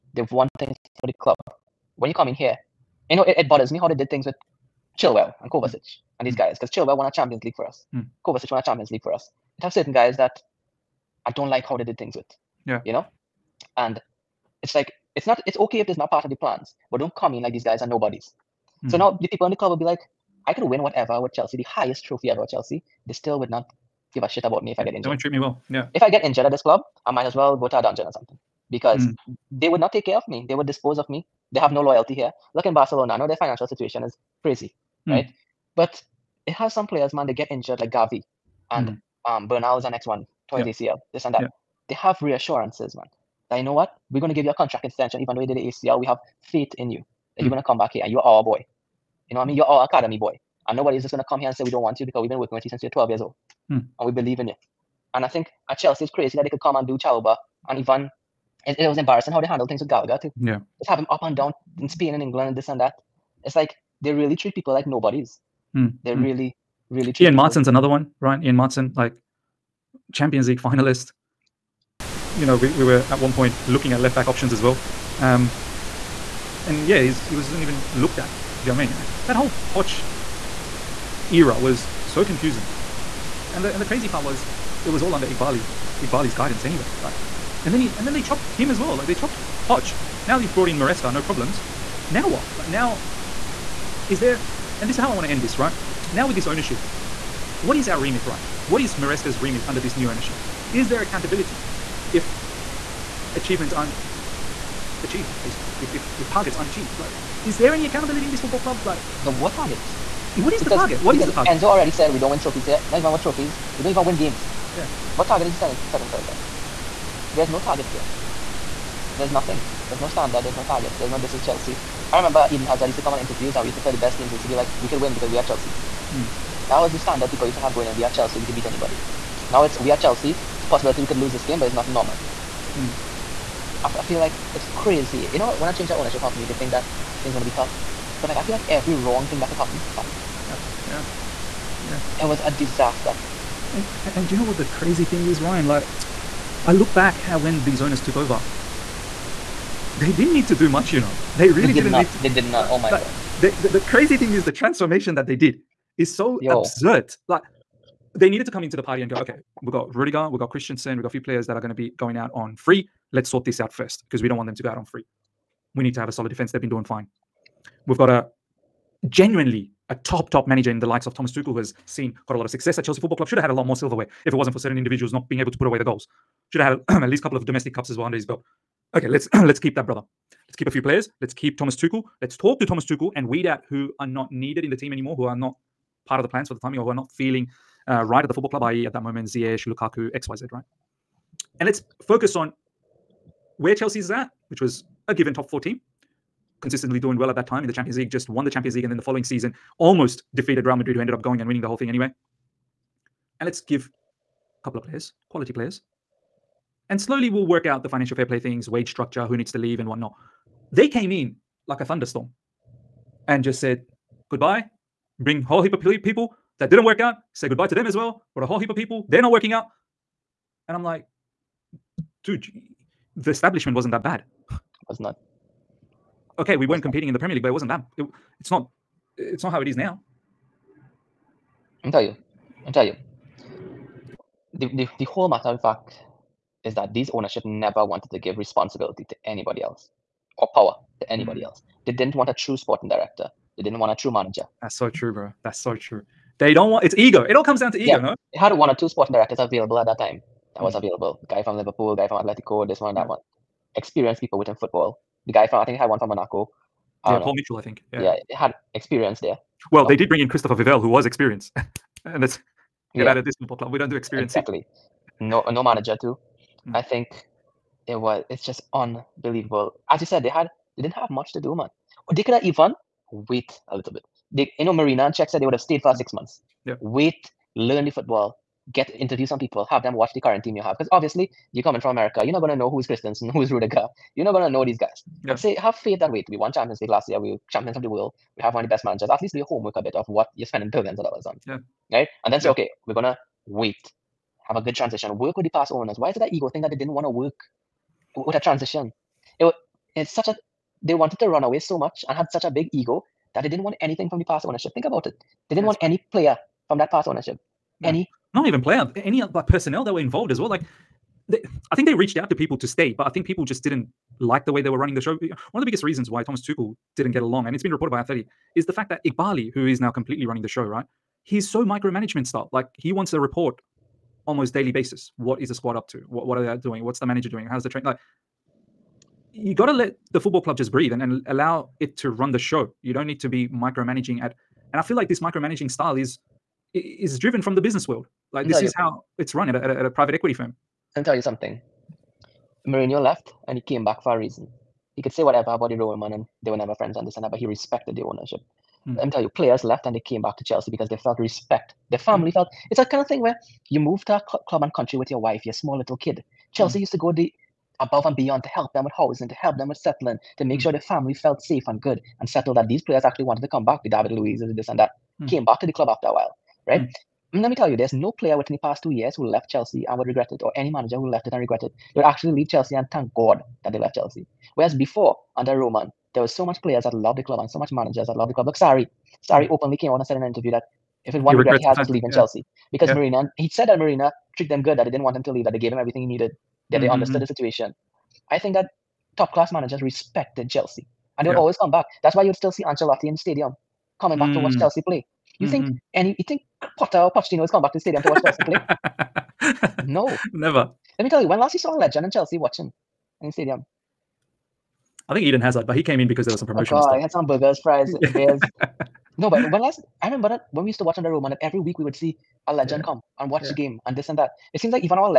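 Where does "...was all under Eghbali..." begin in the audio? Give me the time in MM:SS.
01:24.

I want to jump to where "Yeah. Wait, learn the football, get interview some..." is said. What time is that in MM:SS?
04:36.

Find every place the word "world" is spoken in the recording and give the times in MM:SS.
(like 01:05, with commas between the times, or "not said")
04:47, 05:37.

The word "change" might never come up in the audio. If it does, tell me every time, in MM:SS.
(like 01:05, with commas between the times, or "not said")
02:15.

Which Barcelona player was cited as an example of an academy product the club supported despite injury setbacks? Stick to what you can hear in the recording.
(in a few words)
Gavi.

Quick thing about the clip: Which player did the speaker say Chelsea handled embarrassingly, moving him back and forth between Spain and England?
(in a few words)
Gallagher.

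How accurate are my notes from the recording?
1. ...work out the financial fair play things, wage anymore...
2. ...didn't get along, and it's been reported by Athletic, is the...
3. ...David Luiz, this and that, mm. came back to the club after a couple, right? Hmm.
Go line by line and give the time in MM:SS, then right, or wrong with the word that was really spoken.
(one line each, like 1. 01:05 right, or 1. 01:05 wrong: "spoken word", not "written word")
1. 03:27 wrong: "structure", not "anymore"
2. 05:16 right
3. 06:03 wrong: "while", not "couple".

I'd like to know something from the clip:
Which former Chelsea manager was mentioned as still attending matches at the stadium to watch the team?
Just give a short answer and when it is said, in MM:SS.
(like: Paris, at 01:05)
Ancelotti, at 06:32.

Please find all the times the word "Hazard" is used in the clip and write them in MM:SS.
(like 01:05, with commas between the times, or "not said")
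02:02, 06:45.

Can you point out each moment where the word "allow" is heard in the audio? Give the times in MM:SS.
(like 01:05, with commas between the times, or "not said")
05:31.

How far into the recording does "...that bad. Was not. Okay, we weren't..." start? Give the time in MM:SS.
03:43.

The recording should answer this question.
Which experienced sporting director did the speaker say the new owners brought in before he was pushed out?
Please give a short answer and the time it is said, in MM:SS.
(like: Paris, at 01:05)
Christopher Vivell, at 04:20.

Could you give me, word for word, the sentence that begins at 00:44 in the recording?
We're gonna give you a contract extension, even though you did the ACL, we have faith in you that mm.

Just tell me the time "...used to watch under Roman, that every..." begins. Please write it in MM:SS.
06:50.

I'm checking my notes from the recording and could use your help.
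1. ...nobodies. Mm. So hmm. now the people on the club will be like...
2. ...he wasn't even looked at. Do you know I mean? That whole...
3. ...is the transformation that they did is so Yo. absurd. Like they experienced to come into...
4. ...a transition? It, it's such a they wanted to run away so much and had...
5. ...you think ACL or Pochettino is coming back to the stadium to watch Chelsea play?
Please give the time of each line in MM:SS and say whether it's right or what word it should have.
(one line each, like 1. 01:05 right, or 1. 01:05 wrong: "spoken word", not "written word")
1. 00:17 right
2. 01:17 right
3. 02:34 wrong: "needed", not "experienced"
4. 04:58 right
5. 06:36 wrong: "Potter", not "ACL".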